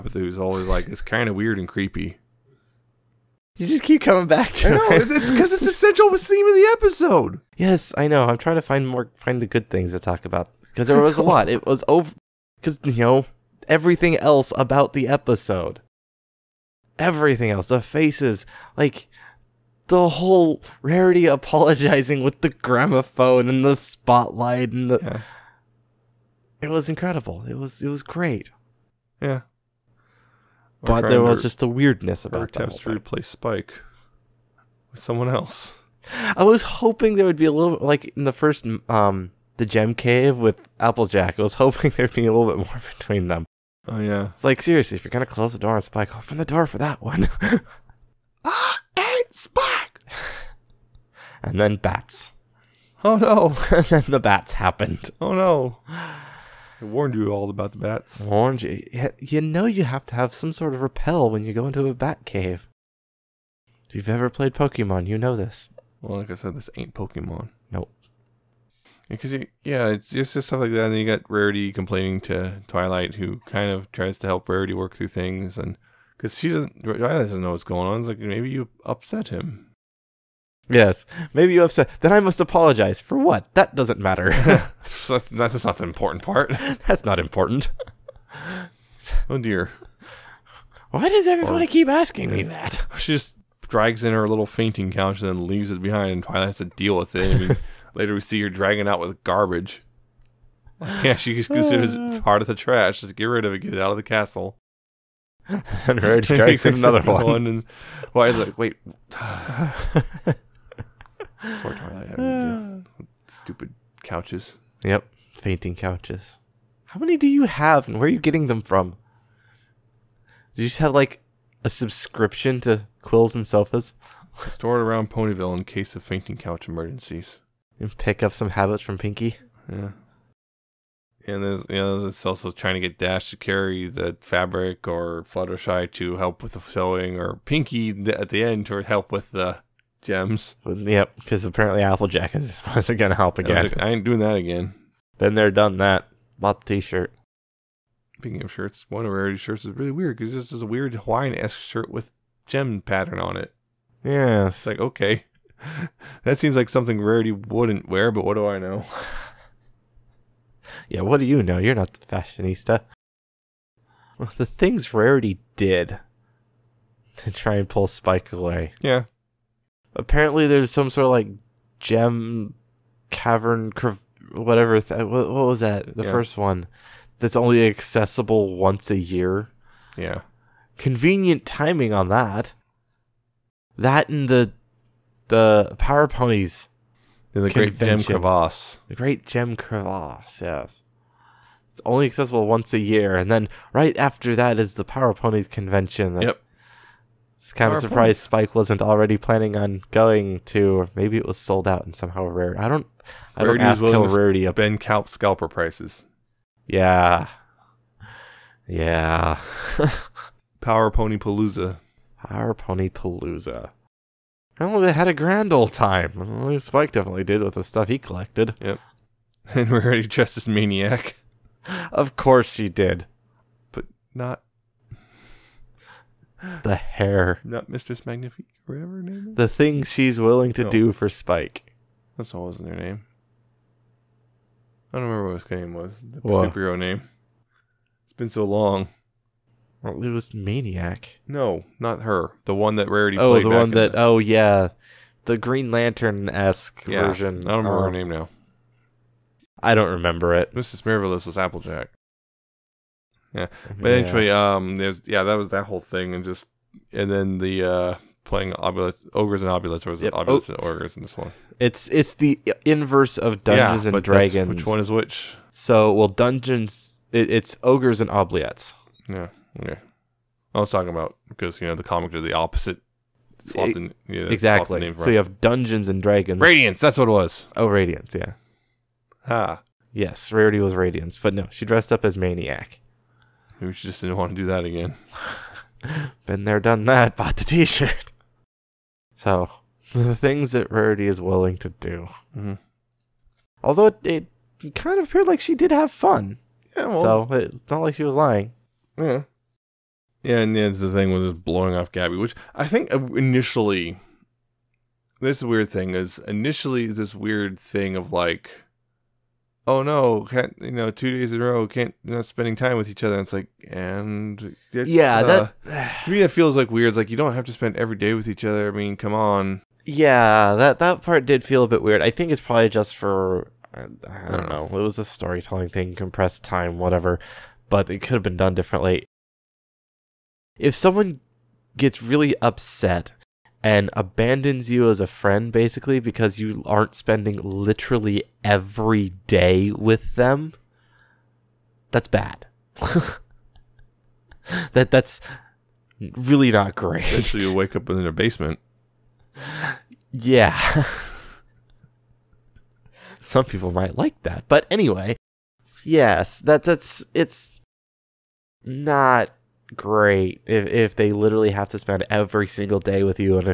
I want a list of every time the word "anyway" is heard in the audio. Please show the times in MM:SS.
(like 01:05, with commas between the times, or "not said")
04:13, 05:54.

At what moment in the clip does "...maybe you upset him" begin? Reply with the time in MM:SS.
01:18.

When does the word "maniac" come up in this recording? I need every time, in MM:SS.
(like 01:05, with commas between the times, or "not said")
03:40, 04:00, 04:42.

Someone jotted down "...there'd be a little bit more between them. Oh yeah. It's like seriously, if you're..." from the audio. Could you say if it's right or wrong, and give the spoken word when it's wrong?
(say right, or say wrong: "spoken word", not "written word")
right.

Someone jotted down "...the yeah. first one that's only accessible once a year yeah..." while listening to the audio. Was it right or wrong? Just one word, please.
right.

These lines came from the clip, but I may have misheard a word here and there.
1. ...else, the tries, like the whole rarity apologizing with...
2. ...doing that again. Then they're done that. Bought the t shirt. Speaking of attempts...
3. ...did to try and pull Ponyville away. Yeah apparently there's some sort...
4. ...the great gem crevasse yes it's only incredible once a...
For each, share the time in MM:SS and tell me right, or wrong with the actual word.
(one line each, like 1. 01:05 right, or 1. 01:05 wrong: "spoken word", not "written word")
1. 00:17 wrong: "faces", not "tries"
2. 02:24 wrong: "shirts", not "attempts"
3. 02:45 wrong: "Spike", not "Ponyville"
4. 03:08 wrong: "accessible", not "incredible".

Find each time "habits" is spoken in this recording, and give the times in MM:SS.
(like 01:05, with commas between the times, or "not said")
02:08.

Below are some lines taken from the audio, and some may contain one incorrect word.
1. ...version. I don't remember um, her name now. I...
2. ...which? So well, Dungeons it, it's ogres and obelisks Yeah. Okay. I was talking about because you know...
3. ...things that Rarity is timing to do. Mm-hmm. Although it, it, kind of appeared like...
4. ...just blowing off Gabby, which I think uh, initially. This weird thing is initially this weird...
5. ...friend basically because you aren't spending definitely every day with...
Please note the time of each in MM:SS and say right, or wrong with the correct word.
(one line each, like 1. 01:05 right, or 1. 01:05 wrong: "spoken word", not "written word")
1. 04:07 right
2. 04:24 right
3. 04:50 wrong: "willing", not "timing"
4. 05:01 right
5. 05:35 wrong: "literally", not "definitely".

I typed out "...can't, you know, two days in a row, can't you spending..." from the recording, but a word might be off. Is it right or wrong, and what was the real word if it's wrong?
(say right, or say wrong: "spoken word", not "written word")
right.